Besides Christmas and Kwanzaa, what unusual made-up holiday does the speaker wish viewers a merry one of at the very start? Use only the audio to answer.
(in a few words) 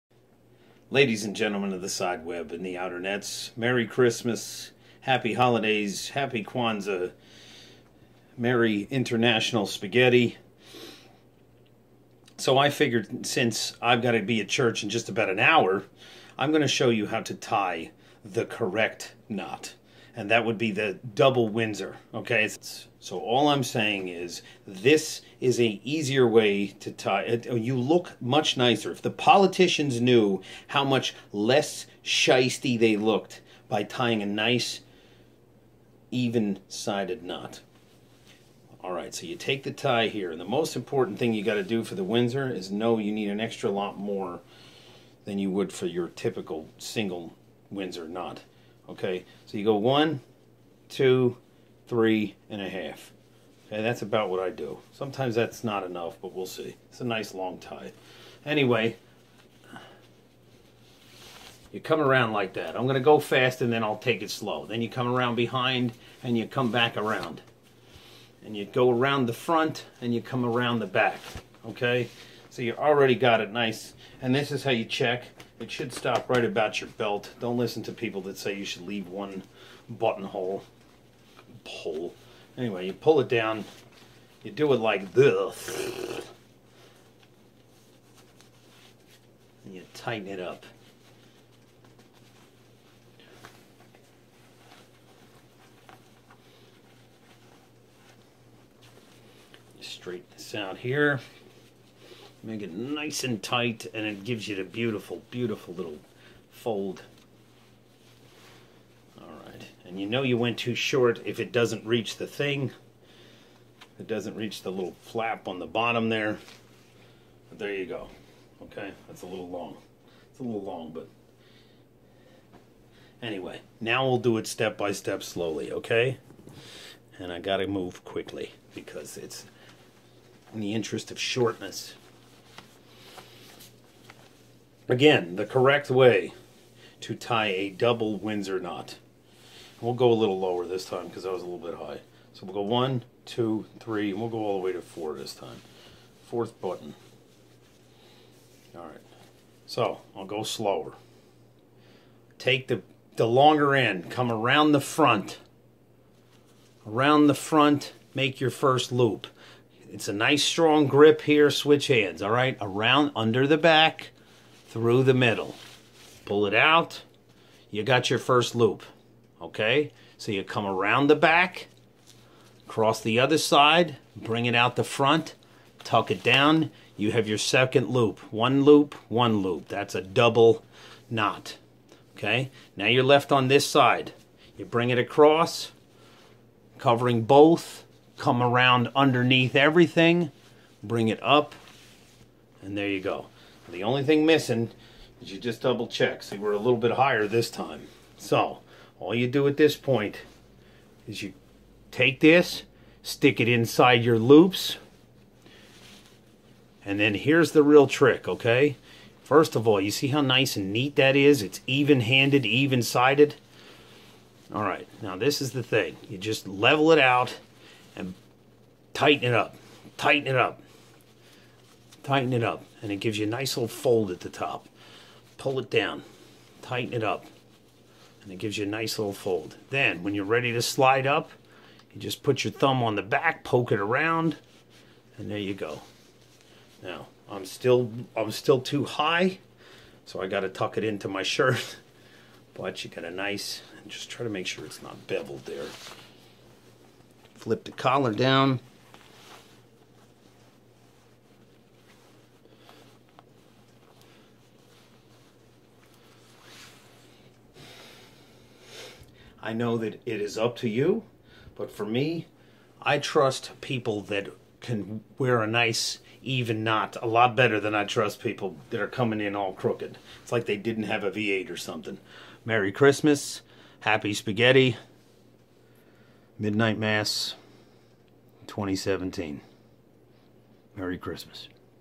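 International Spaghetti.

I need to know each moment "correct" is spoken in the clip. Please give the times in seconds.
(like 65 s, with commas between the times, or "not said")
18 s, 135 s.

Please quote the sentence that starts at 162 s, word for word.
Around, under the back, through the middle.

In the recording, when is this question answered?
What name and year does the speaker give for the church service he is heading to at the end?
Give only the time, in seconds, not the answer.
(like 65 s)
276 s.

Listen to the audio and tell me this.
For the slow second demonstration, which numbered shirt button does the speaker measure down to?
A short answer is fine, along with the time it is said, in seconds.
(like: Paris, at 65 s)
4, at 144 s.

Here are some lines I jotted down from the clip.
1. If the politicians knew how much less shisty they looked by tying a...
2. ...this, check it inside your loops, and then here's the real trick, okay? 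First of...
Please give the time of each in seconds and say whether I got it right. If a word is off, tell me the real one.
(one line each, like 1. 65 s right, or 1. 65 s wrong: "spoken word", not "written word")
1. 28 s right
2. 202 s wrong: "stick", not "check".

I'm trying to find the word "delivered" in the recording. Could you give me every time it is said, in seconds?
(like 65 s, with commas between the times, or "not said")
not said.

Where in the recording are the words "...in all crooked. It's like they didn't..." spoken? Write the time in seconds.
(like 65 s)
269 s.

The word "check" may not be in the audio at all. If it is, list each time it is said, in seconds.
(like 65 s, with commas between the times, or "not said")
74 s, 195 s.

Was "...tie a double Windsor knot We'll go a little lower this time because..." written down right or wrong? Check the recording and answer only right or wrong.
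right.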